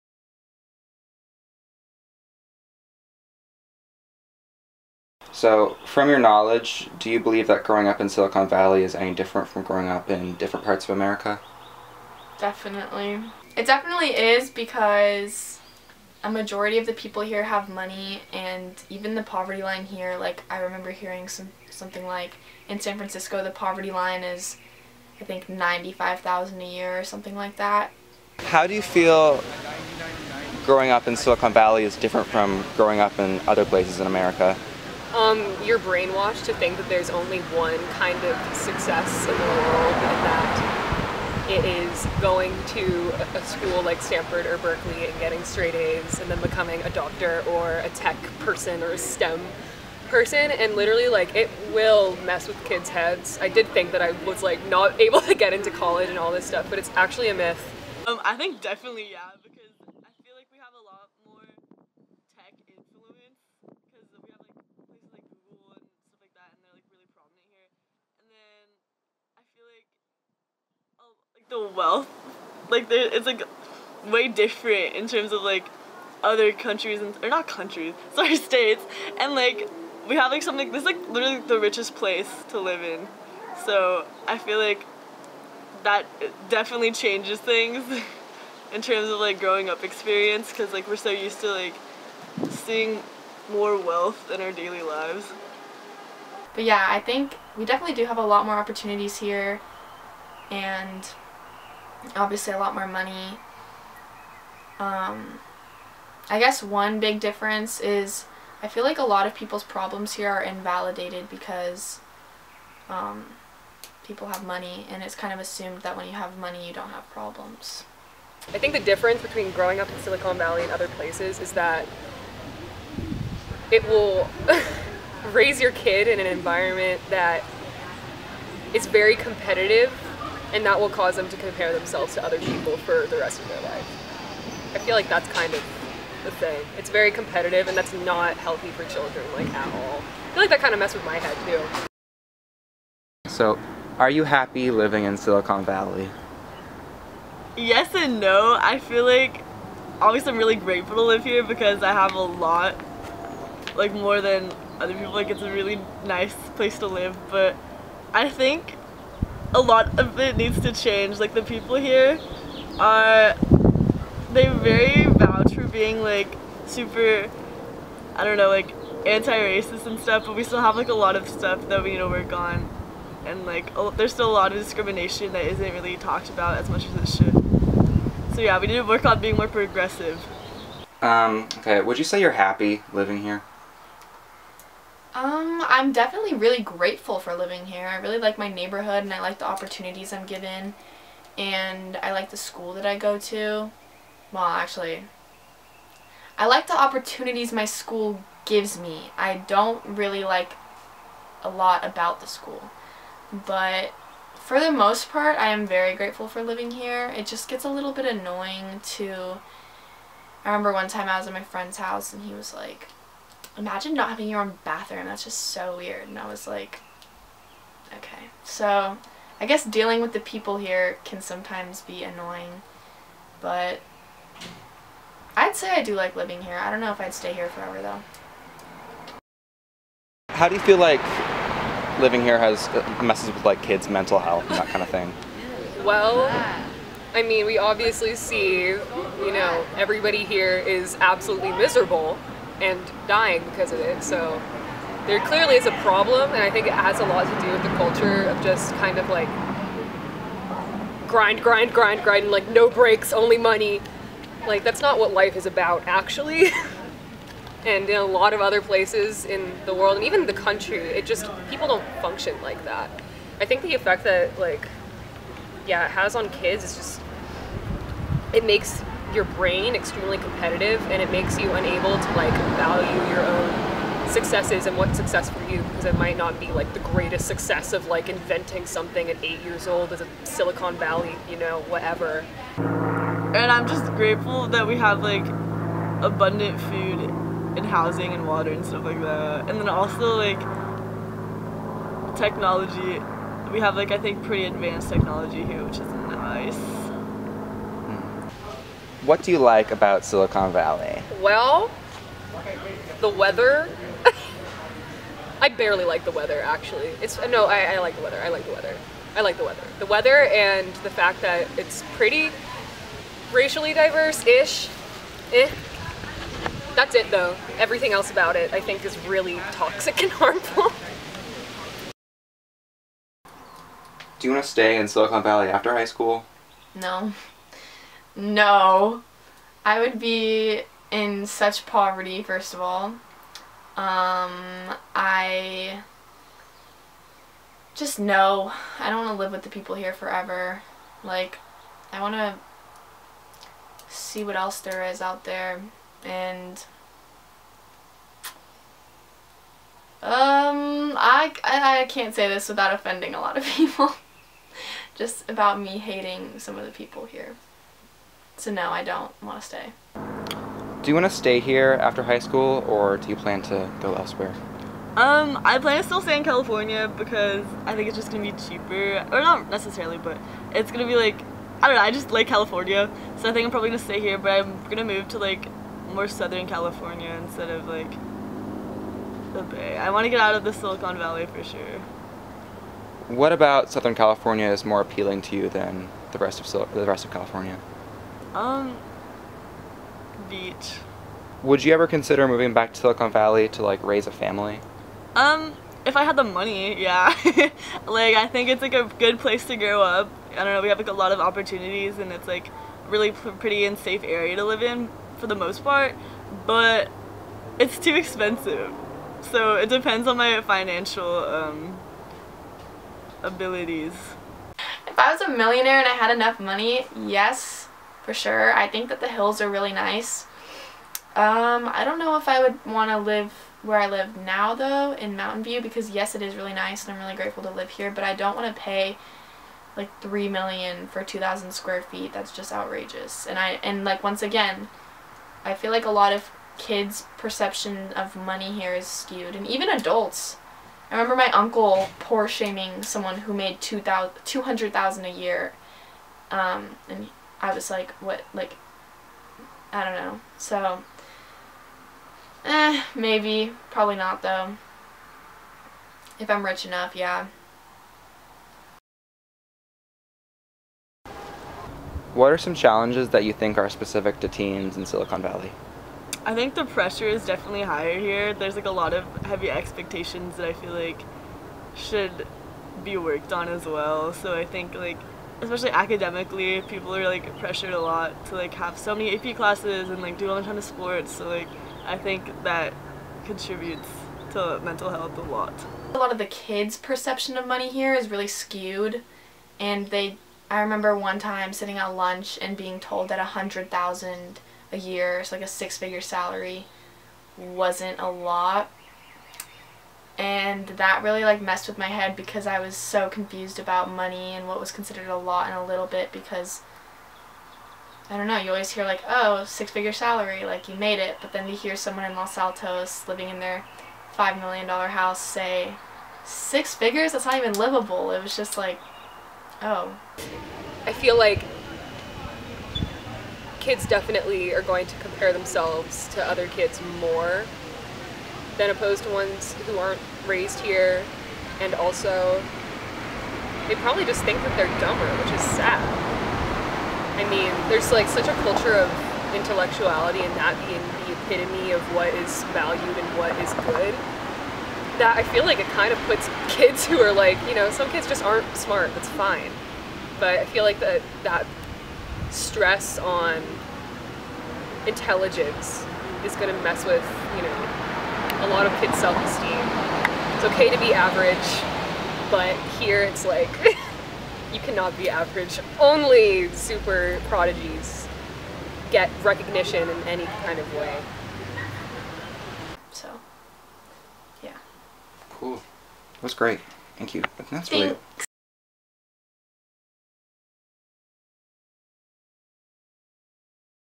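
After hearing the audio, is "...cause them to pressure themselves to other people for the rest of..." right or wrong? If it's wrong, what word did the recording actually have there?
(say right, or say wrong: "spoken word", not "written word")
wrong: "compare", not "pressure".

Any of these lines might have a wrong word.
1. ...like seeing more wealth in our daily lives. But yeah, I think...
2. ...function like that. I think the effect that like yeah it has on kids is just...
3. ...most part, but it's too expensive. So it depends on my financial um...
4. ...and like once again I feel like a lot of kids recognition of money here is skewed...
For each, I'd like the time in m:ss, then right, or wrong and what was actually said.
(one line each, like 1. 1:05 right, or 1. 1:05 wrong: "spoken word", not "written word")
1. 1:31 right
2. 4:22 right
3. 6:45 right
4. 7:13 wrong: "perception", not "recognition".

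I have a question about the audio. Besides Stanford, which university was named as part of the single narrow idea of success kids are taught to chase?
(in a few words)
Berkeley.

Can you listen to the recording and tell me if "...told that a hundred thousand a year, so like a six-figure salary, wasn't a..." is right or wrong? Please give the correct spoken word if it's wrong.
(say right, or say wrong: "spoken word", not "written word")
right.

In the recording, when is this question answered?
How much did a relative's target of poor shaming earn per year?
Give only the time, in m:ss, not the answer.
7:23.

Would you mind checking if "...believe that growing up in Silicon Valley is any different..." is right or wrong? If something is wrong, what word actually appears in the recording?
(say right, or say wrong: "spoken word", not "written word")
right.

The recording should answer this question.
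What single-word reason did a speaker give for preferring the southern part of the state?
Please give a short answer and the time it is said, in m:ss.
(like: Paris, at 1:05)
Beach, at 6:30.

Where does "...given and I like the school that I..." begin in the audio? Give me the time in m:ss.
3:10.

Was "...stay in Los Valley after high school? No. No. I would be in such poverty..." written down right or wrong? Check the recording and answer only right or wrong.
wrong.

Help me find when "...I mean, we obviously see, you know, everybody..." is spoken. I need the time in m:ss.
3:57.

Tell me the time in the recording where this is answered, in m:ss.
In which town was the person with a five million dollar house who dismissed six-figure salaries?
8:32.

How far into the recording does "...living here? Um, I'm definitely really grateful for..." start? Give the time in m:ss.
3:02.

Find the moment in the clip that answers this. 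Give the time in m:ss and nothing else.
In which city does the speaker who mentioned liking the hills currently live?
7:05.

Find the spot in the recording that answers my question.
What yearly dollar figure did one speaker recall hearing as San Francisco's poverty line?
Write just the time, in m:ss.
0:25.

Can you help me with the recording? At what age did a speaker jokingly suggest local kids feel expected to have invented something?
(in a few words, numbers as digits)
8.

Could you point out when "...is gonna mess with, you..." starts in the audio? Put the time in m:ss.
9:16.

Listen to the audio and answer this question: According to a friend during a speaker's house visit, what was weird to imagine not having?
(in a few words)
your own bathroom.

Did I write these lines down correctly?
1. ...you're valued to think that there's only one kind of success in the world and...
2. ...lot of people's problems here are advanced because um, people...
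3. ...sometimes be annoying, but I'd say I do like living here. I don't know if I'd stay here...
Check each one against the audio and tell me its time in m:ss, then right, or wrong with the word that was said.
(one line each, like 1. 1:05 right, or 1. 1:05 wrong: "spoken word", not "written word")
1. 0:35 wrong: "brainwashed", not "valued"
2. 1:49 wrong: "invalidated", not "advanced"
3. 3:41 right.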